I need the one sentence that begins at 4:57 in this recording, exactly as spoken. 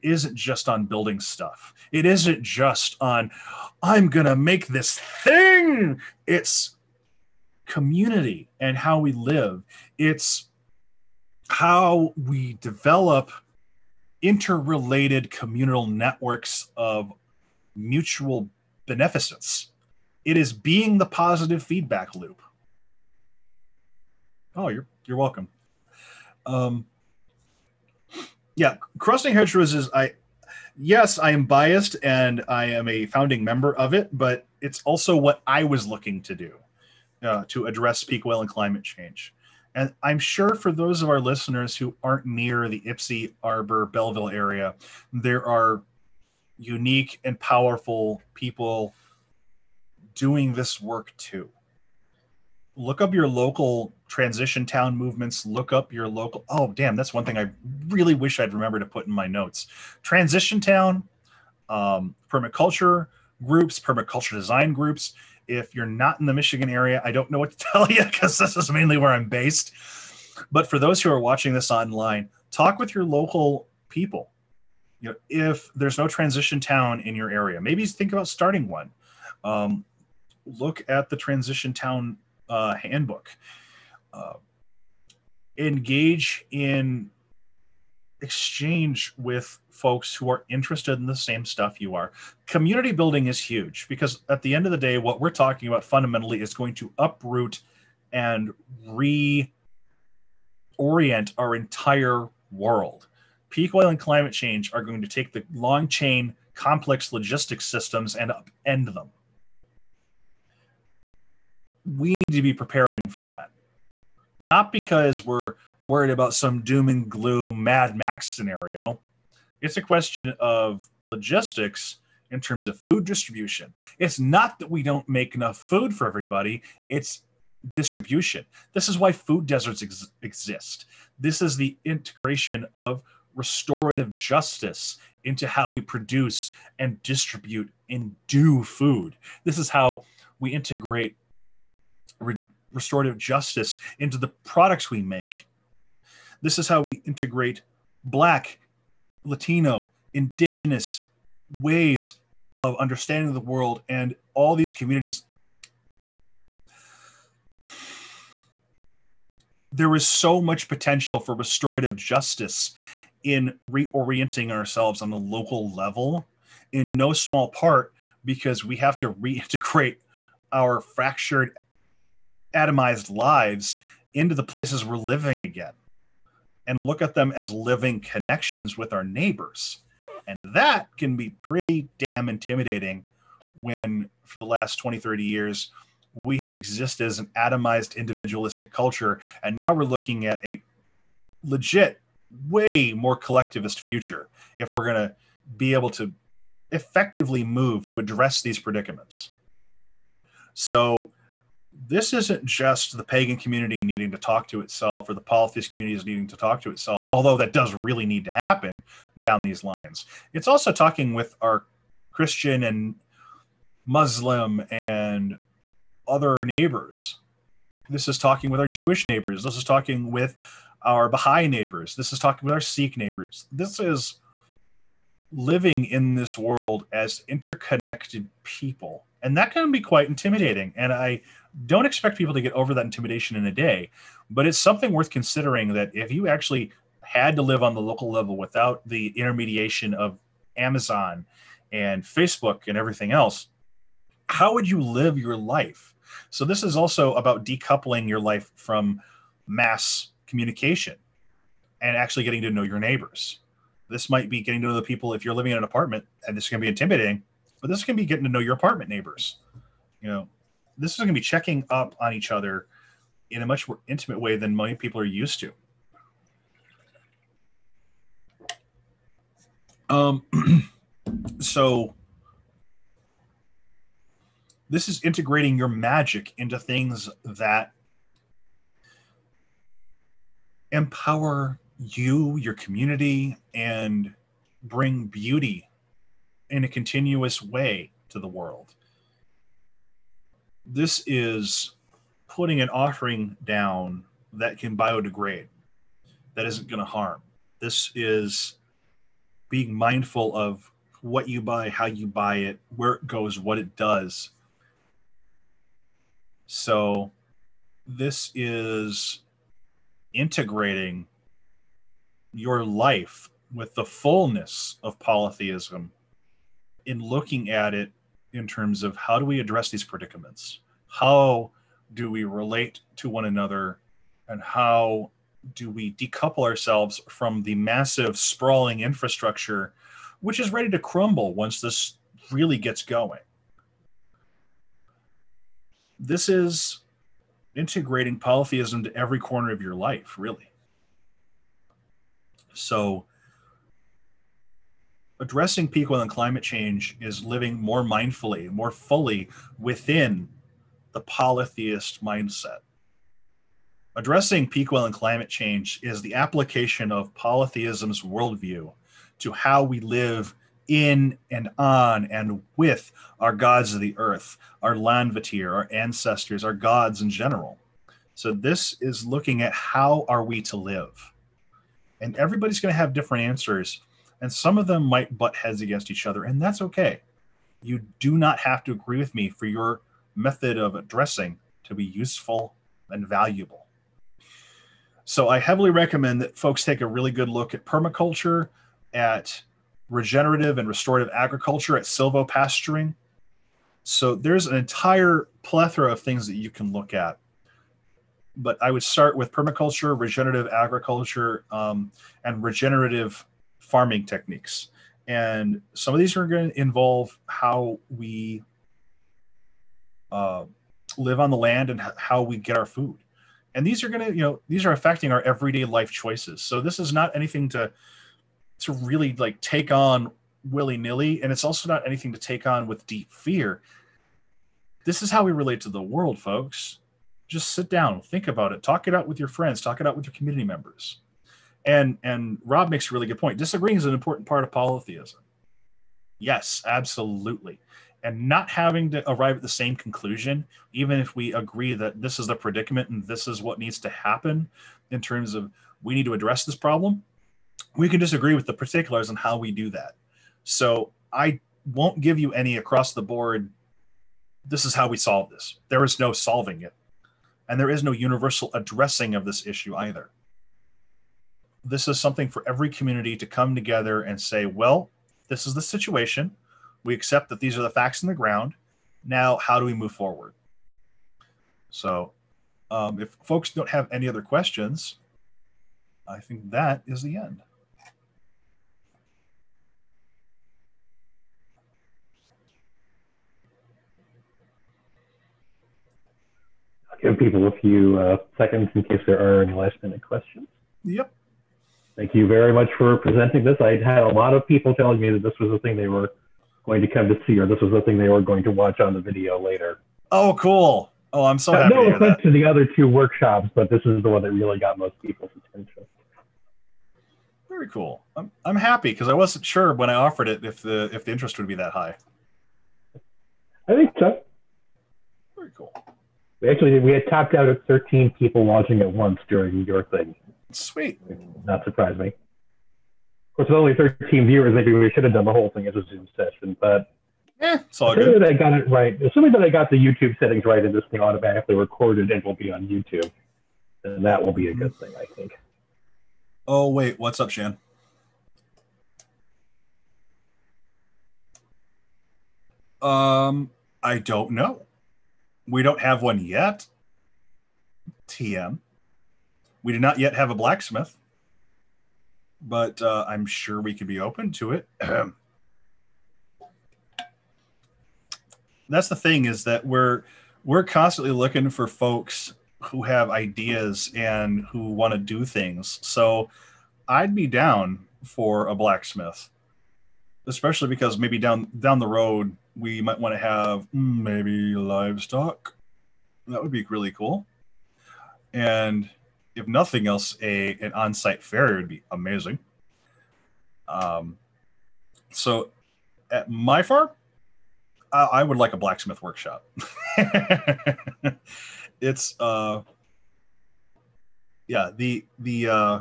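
This is being mindful of what you buy, how you buy it, where it goes, what it does.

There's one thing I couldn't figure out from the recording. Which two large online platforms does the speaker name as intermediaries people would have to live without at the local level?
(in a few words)
Amazon and Facebook.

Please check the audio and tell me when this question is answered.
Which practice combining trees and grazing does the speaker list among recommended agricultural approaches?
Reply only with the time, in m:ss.
6:31.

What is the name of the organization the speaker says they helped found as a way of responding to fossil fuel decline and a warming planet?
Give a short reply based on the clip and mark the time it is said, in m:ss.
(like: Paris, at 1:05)
Crossing Hedgerows, at 0:28.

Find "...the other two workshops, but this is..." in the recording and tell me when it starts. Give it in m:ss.
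8:22.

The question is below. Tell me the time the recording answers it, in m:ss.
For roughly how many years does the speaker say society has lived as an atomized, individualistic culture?
3:04.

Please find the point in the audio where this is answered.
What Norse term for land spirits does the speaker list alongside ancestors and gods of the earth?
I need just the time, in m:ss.
6:04.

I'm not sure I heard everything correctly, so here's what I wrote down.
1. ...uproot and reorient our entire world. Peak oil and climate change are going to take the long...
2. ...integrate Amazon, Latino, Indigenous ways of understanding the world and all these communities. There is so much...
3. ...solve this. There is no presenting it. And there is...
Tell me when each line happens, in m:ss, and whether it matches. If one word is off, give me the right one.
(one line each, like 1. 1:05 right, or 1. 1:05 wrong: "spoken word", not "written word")
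1. 1:36 right
2. 2:27 wrong: "Black", not "Amazon"
3. 7:34 wrong: "solving", not "presenting".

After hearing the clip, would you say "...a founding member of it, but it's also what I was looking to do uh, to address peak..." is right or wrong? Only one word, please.
right.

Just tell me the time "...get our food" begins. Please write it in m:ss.
6:52.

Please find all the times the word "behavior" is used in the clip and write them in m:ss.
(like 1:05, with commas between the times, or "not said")
not said.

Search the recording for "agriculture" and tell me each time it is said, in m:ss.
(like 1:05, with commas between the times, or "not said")
6:31, 6:40.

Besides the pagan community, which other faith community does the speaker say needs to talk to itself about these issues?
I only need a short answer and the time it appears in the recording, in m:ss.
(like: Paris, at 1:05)
polytheist community, at 3:25.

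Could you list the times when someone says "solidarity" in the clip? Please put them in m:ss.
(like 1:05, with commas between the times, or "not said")
not said.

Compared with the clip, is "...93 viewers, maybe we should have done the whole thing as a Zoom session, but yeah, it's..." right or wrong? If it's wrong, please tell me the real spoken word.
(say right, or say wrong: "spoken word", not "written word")
wrong: "13", not "93".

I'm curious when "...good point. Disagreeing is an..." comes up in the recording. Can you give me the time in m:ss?
7:13.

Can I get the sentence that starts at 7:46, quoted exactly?
We accept that these are the facts in the ground.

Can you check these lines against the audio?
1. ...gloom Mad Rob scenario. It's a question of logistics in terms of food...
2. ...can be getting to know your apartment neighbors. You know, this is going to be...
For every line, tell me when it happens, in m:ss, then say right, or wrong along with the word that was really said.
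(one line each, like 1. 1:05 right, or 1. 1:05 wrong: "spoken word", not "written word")
1. 1:57 wrong: "Max", not "Rob"
2. 4:17 right.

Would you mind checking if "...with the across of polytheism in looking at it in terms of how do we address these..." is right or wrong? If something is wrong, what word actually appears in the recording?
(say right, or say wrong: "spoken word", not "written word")
wrong: "fullness", not "across".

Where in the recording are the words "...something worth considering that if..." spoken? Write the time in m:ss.
3:54.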